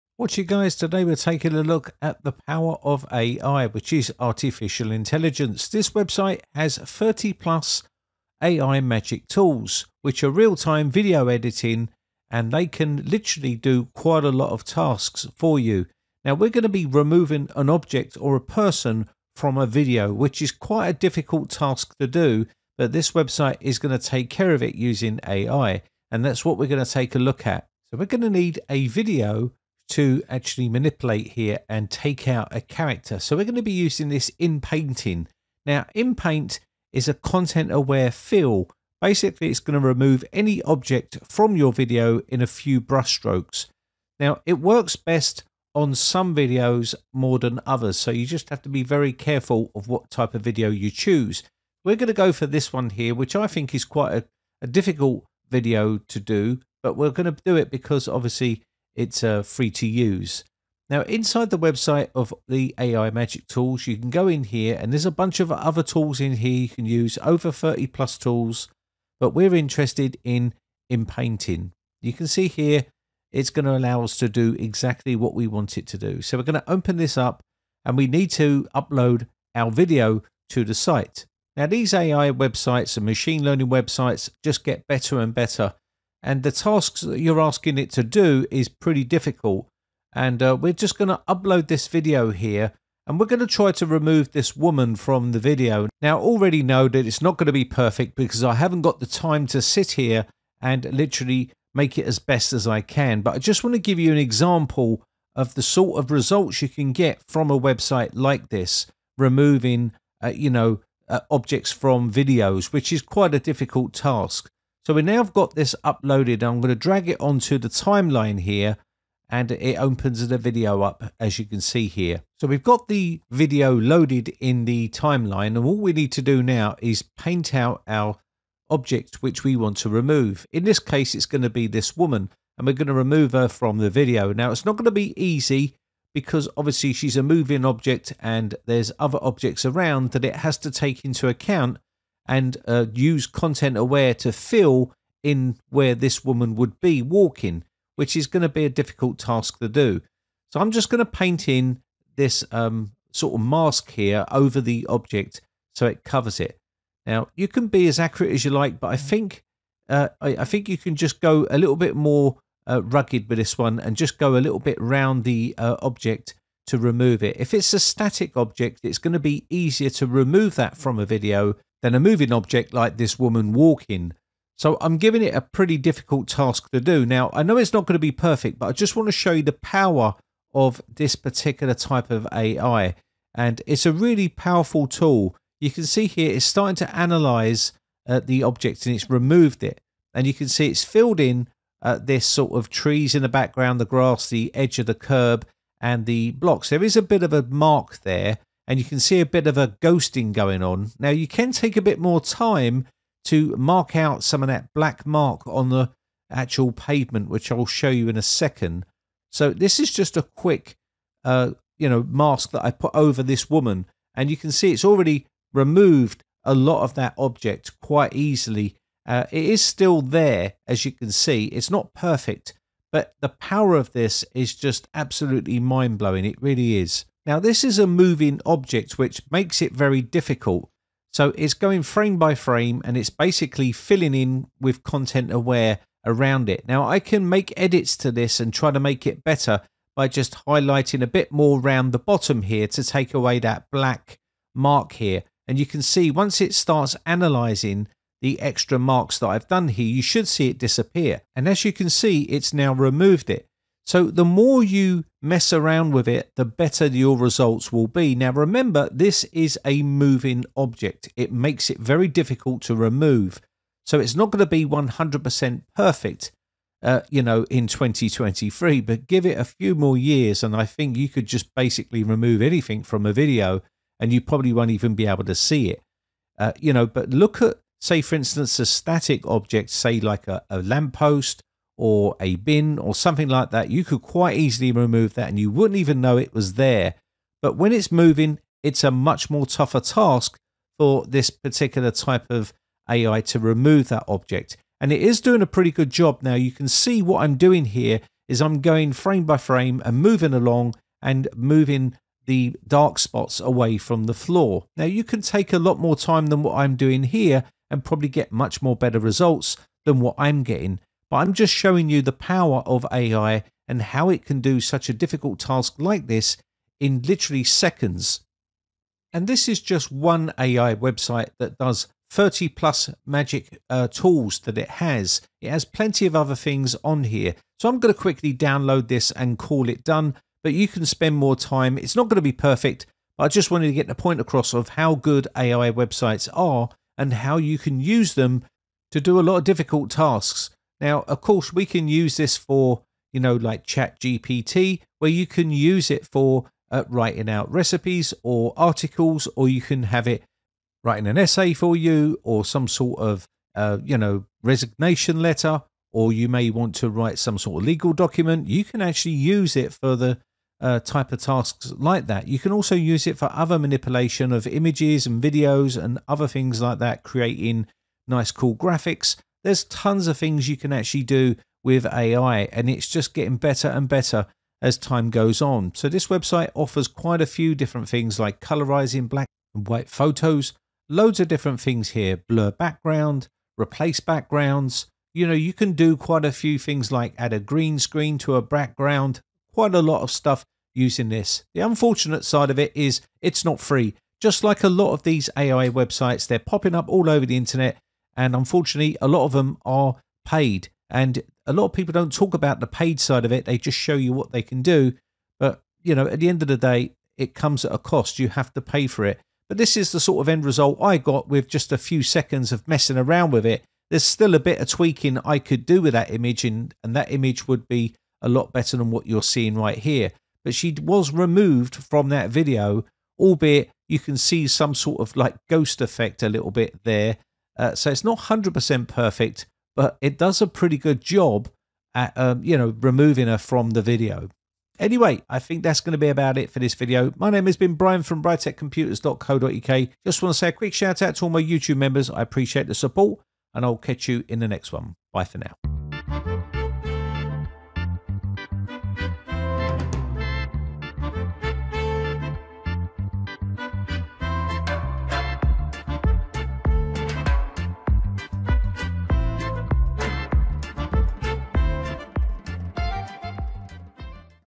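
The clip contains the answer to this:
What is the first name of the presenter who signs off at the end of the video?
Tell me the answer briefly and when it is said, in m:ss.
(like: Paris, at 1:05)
Brian, at 7:17.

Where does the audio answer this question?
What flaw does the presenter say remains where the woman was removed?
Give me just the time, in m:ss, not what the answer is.
3:19.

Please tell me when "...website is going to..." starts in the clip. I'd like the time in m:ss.
0:23.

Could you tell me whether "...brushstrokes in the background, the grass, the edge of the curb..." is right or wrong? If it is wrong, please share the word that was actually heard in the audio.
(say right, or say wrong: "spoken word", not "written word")
wrong: "trees", not "brushstrokes".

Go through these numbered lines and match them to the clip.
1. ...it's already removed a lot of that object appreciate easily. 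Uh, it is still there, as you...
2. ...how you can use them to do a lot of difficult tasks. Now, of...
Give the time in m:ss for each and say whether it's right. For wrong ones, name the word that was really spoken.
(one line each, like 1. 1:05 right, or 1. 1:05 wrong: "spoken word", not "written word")
1. 3:34 wrong: "quite", not "appreciate"
2. 5:37 right.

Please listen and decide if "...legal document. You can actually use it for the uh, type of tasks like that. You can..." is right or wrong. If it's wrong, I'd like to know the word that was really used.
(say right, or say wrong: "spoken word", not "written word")
right.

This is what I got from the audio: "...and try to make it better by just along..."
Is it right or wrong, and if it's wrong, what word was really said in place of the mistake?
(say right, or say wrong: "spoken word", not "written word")
wrong: "highlighting", not "along".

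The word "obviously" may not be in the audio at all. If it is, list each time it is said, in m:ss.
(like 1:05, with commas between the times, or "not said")
0:58, 2:16.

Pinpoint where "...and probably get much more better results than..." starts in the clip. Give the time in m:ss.
5:07.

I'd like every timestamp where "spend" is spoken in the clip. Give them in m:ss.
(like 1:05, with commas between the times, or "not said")
5:30.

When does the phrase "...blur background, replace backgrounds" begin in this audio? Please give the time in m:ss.
6:22.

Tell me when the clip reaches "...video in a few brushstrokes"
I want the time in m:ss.
0:41.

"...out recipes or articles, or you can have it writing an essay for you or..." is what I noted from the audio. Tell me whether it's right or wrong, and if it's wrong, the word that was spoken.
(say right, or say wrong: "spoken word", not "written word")
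right.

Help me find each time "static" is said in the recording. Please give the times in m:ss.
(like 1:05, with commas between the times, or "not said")
2:47, 4:38.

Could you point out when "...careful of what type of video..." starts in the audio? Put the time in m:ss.
0:49.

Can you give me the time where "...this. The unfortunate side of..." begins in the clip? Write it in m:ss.
6:31.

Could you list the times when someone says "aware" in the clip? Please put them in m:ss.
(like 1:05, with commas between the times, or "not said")
0:37, 2:23, 3:55.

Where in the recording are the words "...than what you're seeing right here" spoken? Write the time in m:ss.
6:58.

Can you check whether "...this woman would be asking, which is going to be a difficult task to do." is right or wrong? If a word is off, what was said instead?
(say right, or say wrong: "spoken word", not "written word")
wrong: "walking", not "asking".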